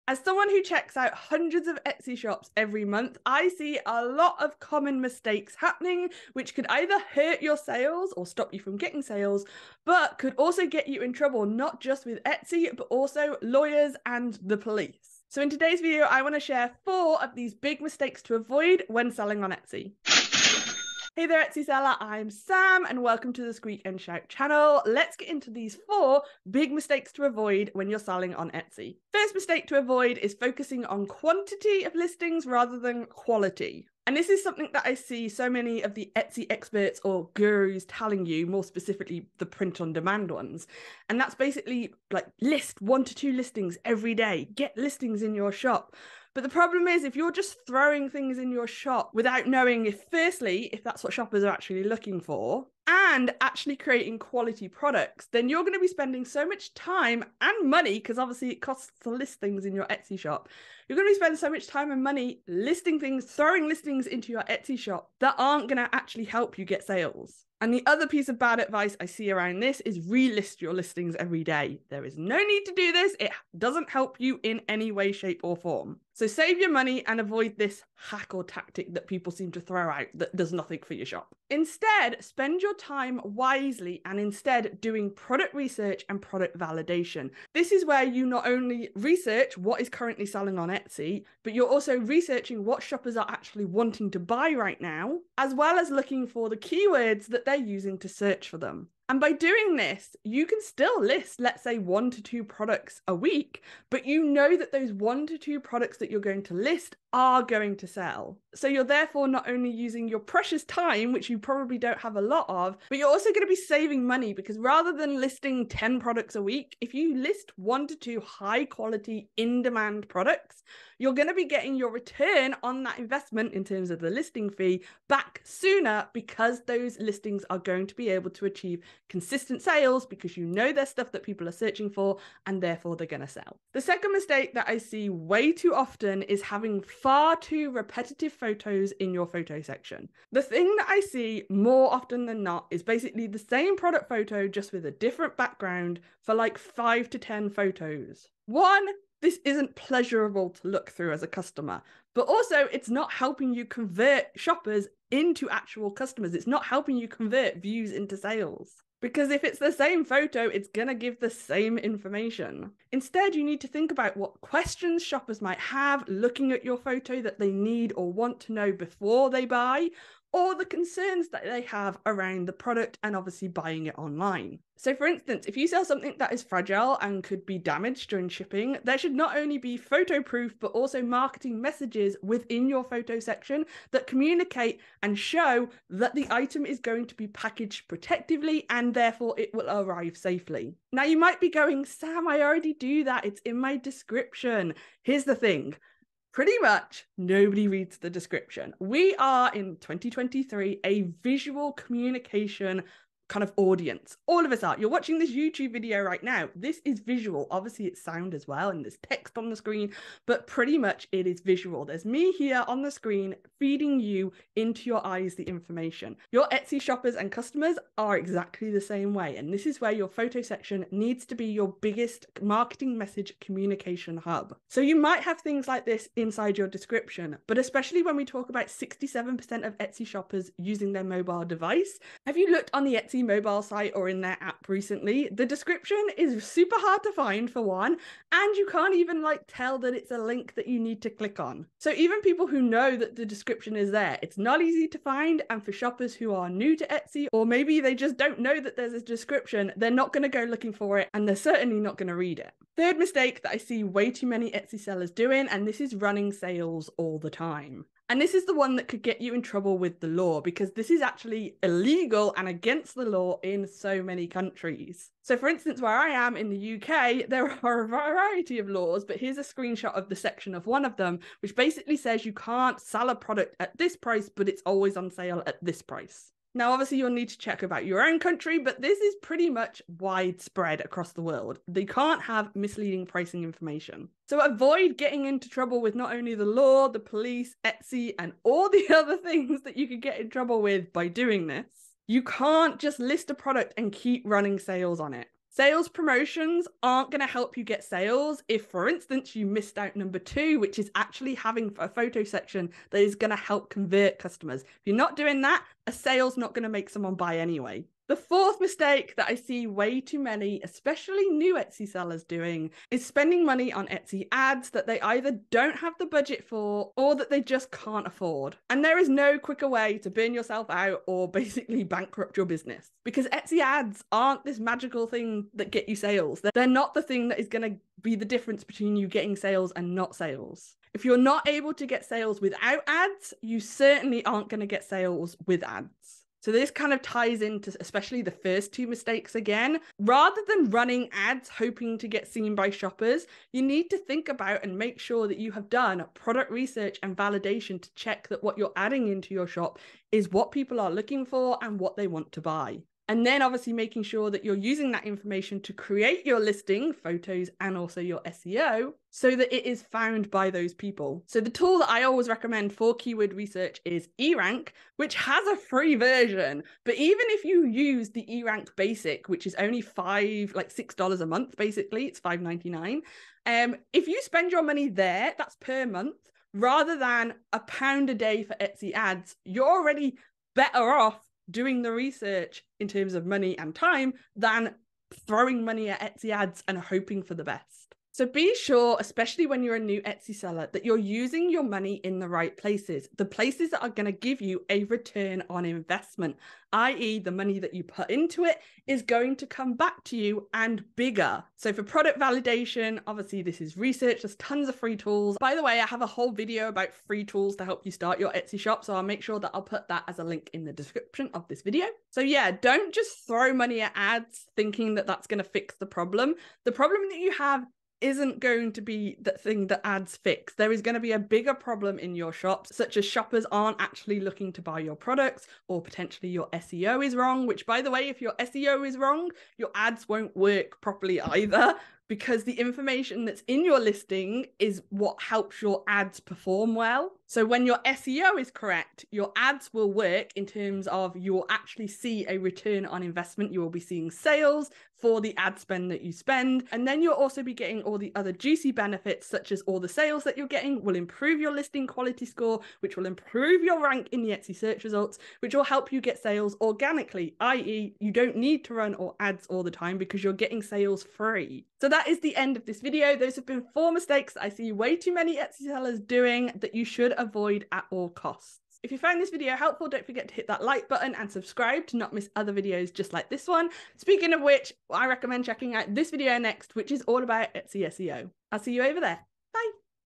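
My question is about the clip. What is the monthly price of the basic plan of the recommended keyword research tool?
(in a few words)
$5.99.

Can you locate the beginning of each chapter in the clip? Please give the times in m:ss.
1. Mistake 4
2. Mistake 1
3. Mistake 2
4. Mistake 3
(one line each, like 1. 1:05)
1. 5:08
2. 0:29
3. 2:13
4. 4:12.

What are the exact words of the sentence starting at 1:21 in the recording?
Instead, spend your your time wisely and instead doing product research and product validation.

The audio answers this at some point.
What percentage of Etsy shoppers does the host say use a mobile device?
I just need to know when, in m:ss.
3:48.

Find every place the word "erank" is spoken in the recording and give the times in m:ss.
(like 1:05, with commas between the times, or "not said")
6:04, 6:08.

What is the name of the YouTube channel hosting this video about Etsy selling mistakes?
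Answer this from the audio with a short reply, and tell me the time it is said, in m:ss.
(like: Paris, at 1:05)
Squeak and Shout, at 0:23.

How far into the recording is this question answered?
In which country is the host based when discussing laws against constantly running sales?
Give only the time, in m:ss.
4:26.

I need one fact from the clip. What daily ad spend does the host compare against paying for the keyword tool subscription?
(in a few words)
a pound a day.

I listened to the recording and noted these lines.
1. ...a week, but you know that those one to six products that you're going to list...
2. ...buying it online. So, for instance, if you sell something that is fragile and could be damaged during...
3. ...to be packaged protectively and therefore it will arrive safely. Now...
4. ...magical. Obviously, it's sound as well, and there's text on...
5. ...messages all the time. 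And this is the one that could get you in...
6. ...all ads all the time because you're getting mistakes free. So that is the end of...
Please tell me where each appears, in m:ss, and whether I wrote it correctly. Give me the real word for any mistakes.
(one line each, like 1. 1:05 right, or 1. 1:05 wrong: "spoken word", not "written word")
1. 1:43 wrong: "two", not "six"
2. 2:53 right
3. 3:07 right
4. 3:26 wrong: "visual", not "magical"
5. 4:16 wrong: "sales", not "messages"
6. 7:38 wrong: "sales", not "mistakes".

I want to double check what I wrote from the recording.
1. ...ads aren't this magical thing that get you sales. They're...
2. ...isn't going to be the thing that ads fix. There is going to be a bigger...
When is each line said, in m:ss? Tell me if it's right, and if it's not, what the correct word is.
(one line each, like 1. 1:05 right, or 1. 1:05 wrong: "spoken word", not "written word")
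1. 5:23 right
2. 6:58 right.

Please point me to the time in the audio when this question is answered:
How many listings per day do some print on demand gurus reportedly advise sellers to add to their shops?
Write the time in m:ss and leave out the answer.
0:42.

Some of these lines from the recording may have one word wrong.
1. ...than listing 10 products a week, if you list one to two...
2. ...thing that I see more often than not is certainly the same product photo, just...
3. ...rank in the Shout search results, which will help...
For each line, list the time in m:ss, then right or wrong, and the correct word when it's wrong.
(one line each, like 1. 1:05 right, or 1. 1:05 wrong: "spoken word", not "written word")
1. 1:54 right
2. 2:20 wrong: "basically", not "certainly"
3. 7:33 wrong: "Etsy", not "Shout".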